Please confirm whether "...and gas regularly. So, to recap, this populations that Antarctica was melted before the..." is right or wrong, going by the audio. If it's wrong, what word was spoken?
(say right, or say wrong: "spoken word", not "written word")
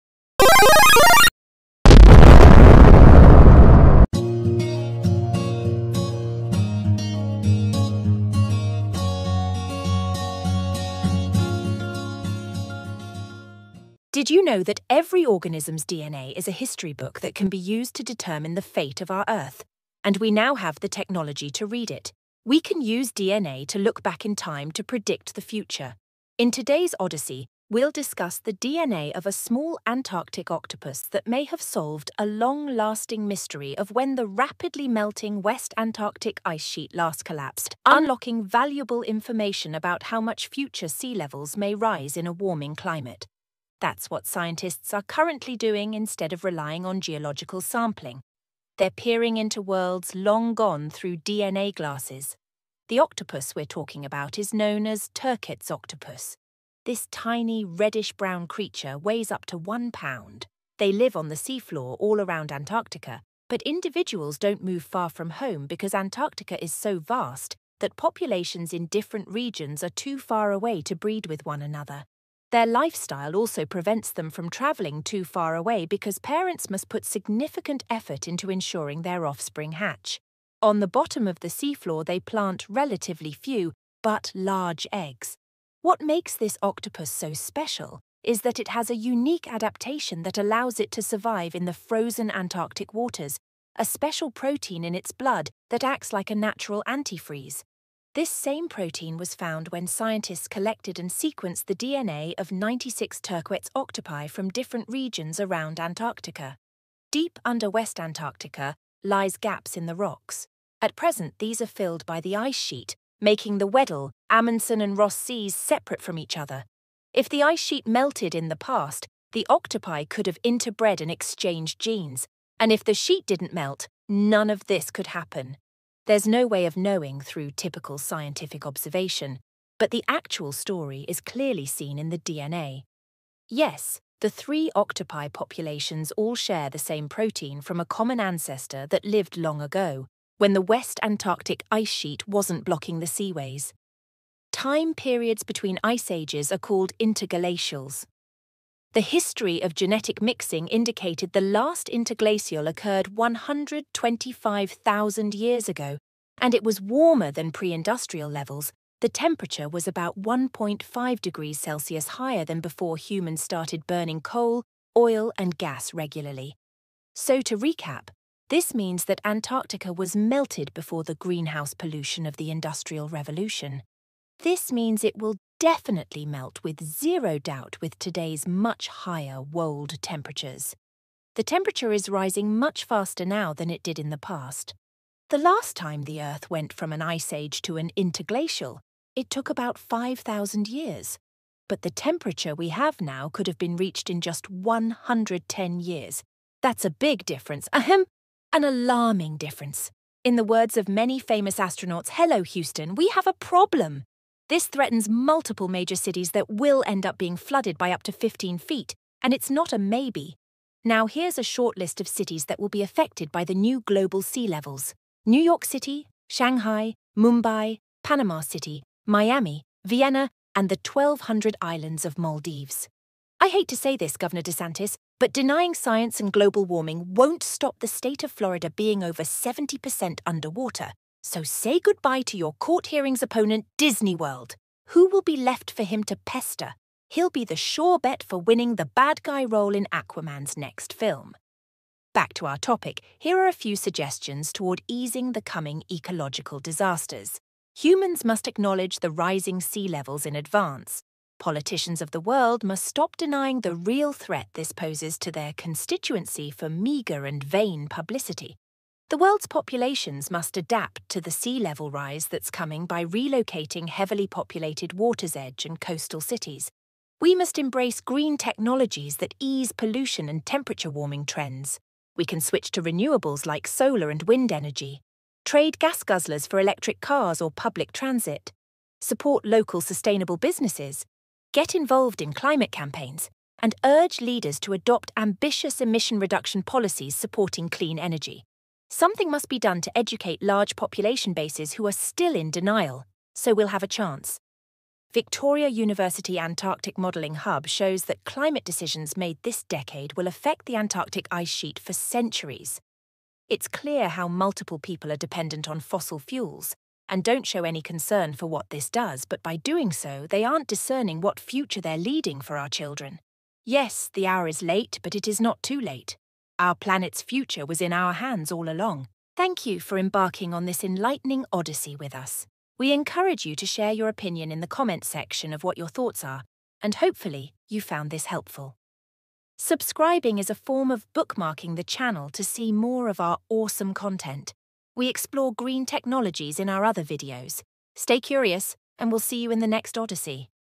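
wrong: "means", not "populations".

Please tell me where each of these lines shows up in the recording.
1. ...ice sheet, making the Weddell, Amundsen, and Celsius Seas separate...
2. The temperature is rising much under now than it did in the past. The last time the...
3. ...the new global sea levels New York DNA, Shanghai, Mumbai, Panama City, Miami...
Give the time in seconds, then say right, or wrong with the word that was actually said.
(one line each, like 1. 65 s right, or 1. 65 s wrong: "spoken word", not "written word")
1. 112 s wrong: "Ross", not "Celsius"
2. 181 s wrong: "faster", not "under"
3. 213 s wrong: "City", not "DNA".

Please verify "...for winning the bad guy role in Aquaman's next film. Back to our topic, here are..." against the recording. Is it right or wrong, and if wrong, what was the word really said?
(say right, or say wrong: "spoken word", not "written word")
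right.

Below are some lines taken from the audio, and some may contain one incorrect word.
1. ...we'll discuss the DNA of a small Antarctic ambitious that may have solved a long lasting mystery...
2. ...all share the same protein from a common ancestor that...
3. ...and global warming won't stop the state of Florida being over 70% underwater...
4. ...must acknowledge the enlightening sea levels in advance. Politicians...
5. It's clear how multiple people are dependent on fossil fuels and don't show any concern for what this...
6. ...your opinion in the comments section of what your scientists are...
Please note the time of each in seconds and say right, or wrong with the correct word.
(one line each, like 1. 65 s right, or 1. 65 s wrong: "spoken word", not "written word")
1. 27 s wrong: "octopus", not "ambitious"
2. 136 s right
3. 226 s right
4. 248 s wrong: "rising", not "enlightening"
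5. 303 s right
6. 323 s wrong: "thoughts", not "scientists".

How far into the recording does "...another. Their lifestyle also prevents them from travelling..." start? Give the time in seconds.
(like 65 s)
71 s.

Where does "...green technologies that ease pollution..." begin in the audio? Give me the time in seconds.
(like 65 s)
267 s.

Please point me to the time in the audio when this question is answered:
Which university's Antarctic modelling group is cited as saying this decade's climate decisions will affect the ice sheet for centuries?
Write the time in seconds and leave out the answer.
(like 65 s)
295 s.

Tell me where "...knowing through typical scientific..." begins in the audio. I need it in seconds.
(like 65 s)
126 s.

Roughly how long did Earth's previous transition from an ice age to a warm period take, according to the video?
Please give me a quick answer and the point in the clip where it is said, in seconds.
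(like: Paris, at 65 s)
5,000 years, at 189 s.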